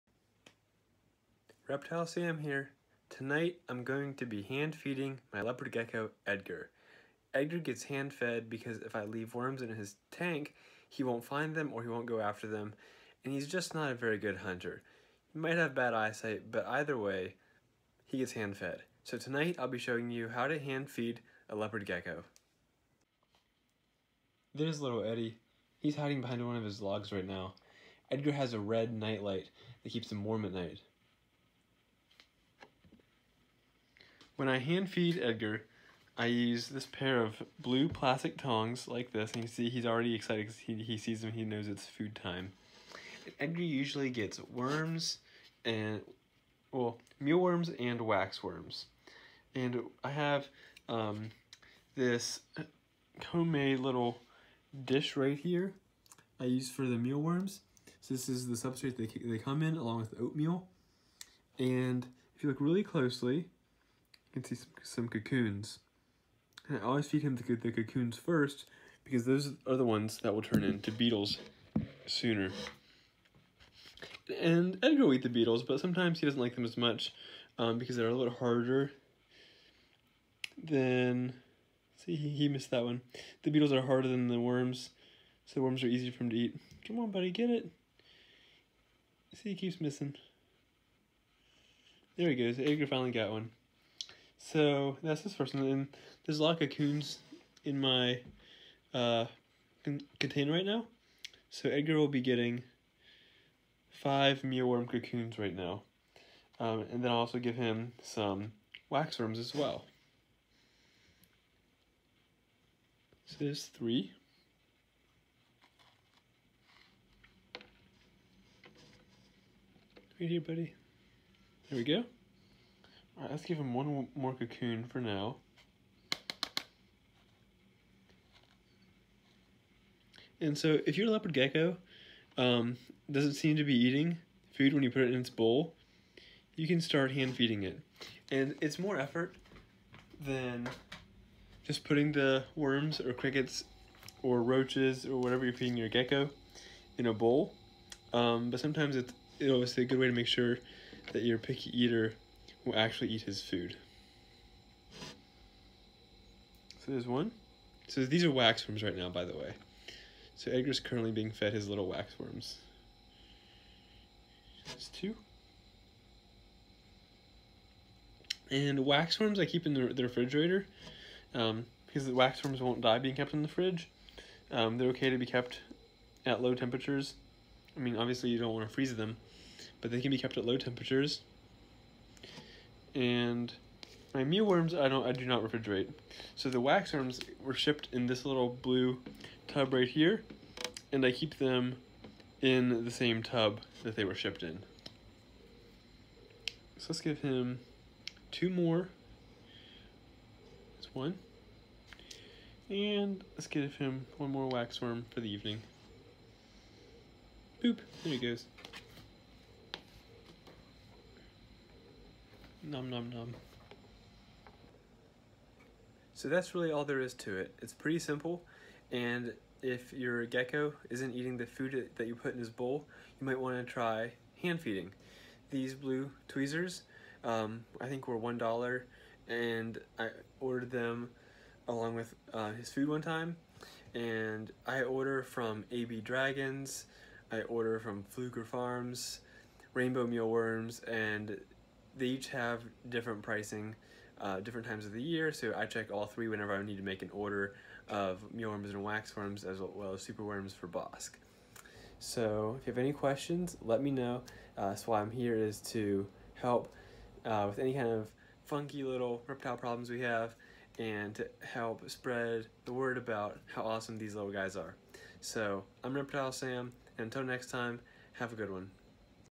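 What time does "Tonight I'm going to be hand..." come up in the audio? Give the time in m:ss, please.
0:03.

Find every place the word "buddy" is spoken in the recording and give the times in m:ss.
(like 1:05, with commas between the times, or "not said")
1:27, 2:00.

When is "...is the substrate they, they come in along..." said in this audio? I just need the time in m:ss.
0:58.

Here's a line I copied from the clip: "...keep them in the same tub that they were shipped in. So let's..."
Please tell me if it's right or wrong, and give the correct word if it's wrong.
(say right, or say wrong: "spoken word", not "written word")
right.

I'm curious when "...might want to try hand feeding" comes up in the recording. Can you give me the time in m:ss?
3:43.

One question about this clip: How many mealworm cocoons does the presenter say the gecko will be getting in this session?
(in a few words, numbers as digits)
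5.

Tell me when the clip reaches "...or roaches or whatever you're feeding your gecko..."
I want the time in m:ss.
2:24.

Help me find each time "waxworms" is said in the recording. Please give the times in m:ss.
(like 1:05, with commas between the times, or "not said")
0:47, 1:48, 3:06, 3:24, 4:08.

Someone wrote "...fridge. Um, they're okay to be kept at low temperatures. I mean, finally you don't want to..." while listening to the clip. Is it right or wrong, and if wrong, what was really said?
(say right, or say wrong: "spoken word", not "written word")
wrong: "obviously", not "finally".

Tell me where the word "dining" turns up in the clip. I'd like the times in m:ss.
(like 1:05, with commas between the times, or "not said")
not said.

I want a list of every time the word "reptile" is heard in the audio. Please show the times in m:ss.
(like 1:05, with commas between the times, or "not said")
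0:01, 4:19, 4:25.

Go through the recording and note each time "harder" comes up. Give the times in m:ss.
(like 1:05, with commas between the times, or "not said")
1:18, 1:23.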